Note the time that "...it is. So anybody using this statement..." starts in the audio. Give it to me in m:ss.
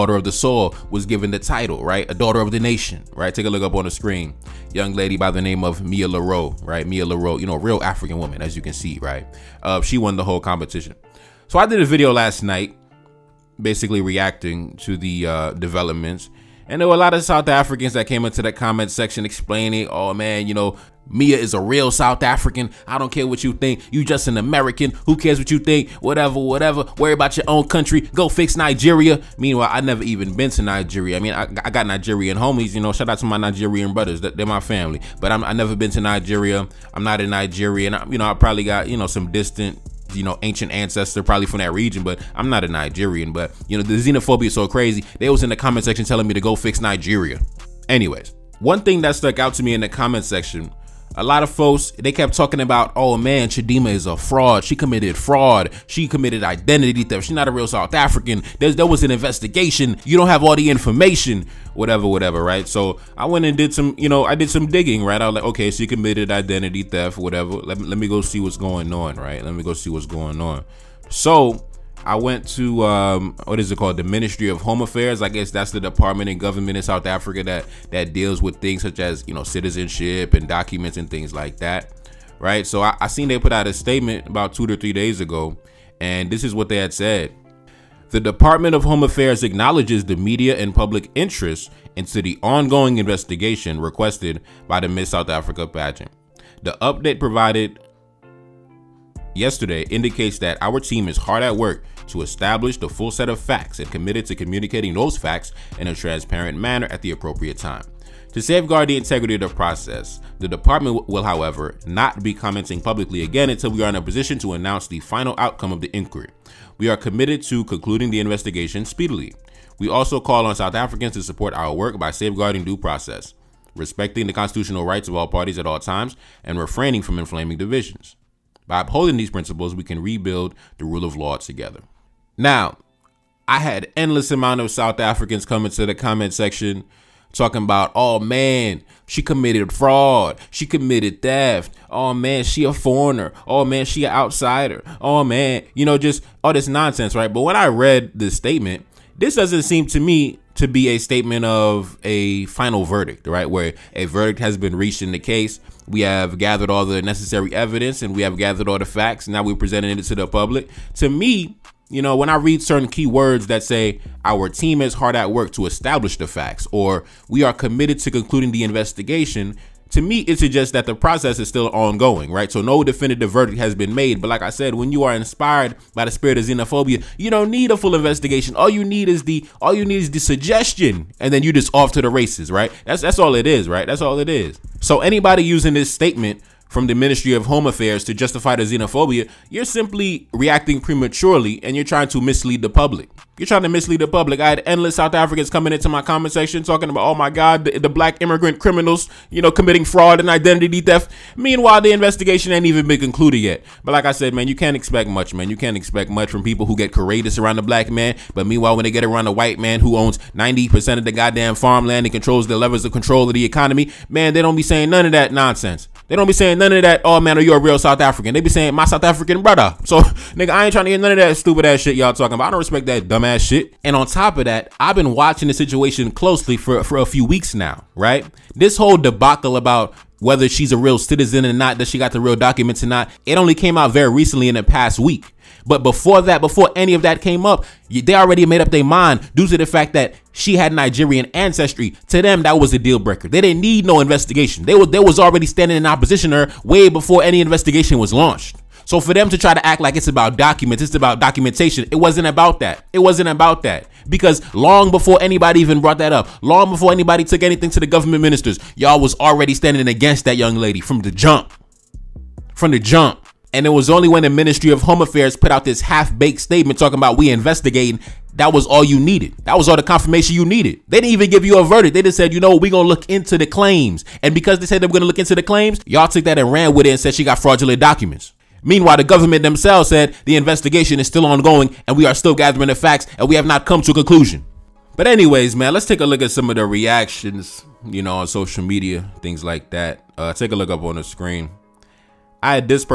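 3:04.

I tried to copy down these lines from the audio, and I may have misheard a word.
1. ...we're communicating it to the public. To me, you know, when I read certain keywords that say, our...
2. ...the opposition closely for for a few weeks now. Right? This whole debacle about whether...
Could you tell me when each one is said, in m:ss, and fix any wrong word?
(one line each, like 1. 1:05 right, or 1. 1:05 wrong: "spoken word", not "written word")
1. 2:39 wrong: "presenting", not "communicating"
2. 3:45 wrong: "situation", not "opposition".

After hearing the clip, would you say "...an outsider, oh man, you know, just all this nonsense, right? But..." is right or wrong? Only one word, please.
right.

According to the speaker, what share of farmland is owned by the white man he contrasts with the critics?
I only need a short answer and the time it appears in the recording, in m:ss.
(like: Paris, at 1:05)
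90%, at 3:30.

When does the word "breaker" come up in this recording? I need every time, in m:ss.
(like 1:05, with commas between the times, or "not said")
4:02.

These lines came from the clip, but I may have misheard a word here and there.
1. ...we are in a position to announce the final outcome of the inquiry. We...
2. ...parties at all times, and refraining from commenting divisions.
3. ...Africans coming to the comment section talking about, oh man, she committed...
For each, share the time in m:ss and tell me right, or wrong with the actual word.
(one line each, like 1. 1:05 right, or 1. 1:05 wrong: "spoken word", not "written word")
1. 1:53 right
2. 2:05 wrong: "inflaming", not "commenting"
3. 2:15 right.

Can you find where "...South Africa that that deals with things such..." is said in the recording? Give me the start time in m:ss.
1:16.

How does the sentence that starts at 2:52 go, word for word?
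So no definitive verdict has been made.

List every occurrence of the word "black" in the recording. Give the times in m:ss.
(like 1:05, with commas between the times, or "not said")
3:17, 3:27.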